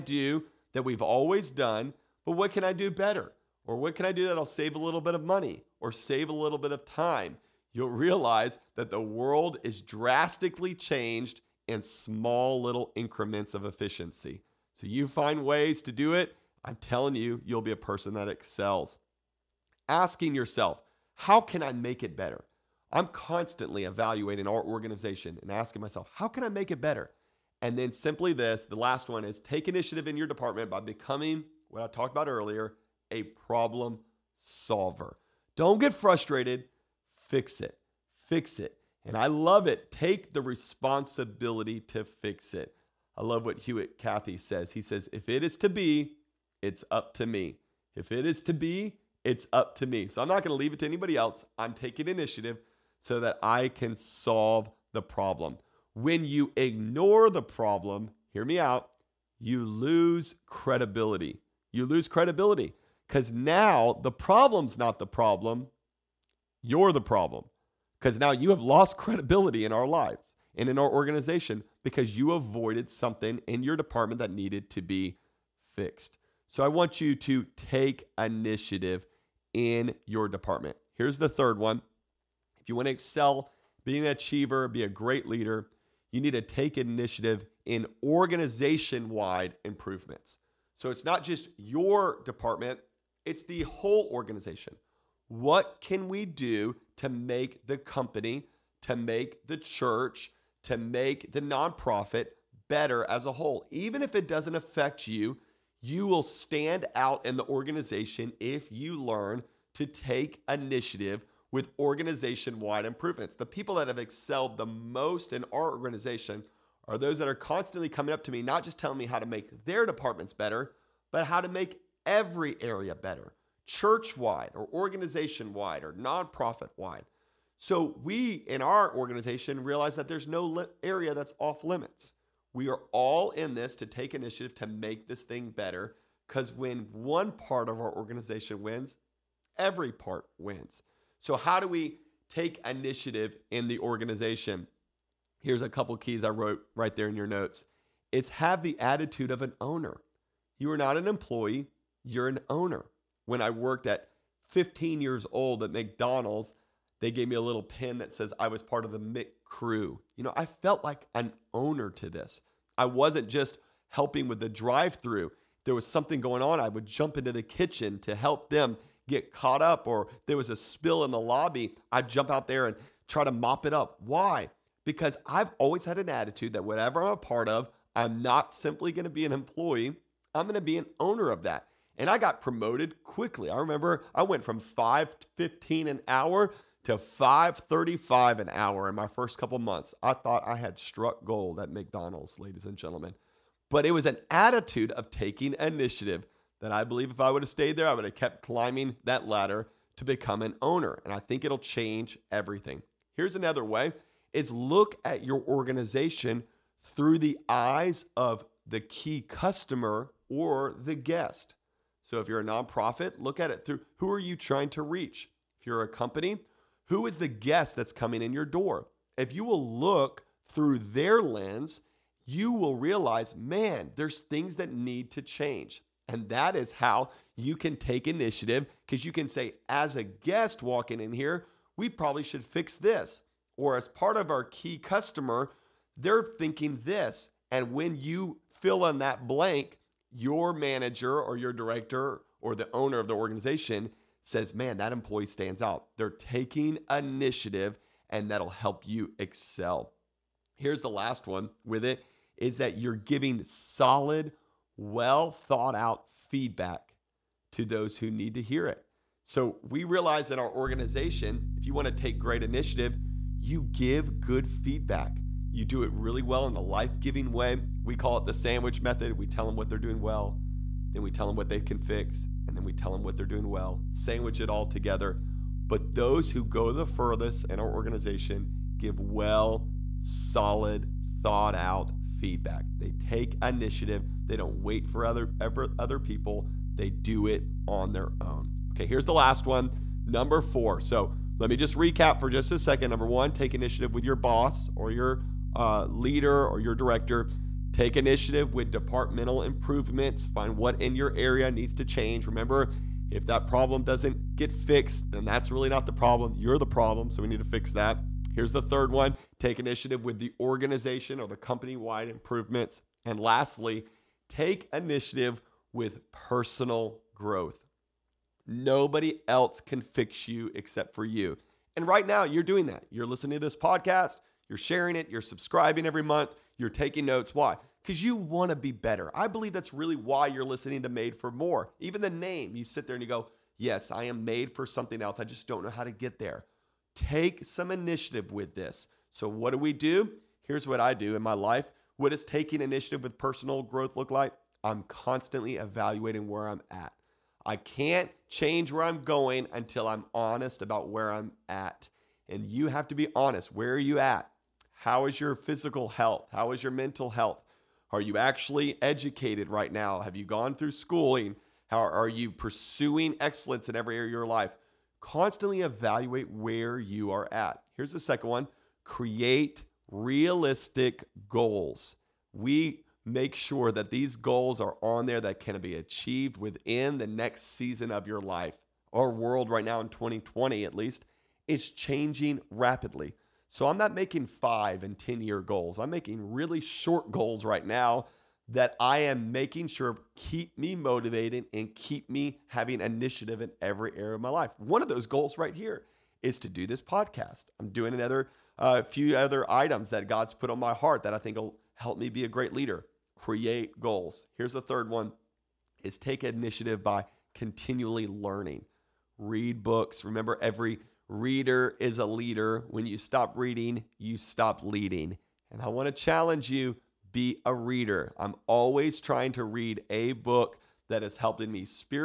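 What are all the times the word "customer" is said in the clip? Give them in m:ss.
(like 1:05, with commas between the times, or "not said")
3:29, 3:54.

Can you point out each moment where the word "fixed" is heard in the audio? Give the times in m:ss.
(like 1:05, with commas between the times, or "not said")
1:15, 5:04.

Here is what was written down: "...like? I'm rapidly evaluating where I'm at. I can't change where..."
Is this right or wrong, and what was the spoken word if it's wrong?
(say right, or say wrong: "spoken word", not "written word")
wrong: "constantly", not "rapidly".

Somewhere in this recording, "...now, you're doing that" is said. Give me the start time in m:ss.
5:22.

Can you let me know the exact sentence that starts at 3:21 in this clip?
And I think it'll change everything.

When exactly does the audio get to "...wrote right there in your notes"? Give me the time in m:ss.
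2:26.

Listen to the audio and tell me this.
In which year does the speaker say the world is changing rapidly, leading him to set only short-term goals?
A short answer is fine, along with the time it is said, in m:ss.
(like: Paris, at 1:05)
2020, at 6:19.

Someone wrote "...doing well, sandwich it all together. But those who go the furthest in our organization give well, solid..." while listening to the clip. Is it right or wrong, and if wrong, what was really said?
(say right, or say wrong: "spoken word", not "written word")
right.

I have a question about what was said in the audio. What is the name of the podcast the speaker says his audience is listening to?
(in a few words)
Made for More.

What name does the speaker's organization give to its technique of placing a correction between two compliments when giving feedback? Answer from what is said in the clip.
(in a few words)
sandwich method.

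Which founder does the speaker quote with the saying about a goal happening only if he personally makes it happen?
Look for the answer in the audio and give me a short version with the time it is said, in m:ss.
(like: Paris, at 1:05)
Truett Cathy, at 0:43.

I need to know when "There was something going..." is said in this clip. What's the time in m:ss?
2:45.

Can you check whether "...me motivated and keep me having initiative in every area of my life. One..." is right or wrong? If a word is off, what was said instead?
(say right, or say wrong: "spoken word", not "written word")
right.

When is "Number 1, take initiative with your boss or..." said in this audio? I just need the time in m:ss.
4:52.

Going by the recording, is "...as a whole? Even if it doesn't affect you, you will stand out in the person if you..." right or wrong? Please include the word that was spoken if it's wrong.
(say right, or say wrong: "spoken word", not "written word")
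wrong: "organization", not "person".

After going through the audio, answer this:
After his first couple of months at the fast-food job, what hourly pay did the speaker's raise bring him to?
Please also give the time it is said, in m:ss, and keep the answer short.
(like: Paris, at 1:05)
$5.35, at 3:06.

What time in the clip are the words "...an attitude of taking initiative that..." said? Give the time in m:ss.
3:14.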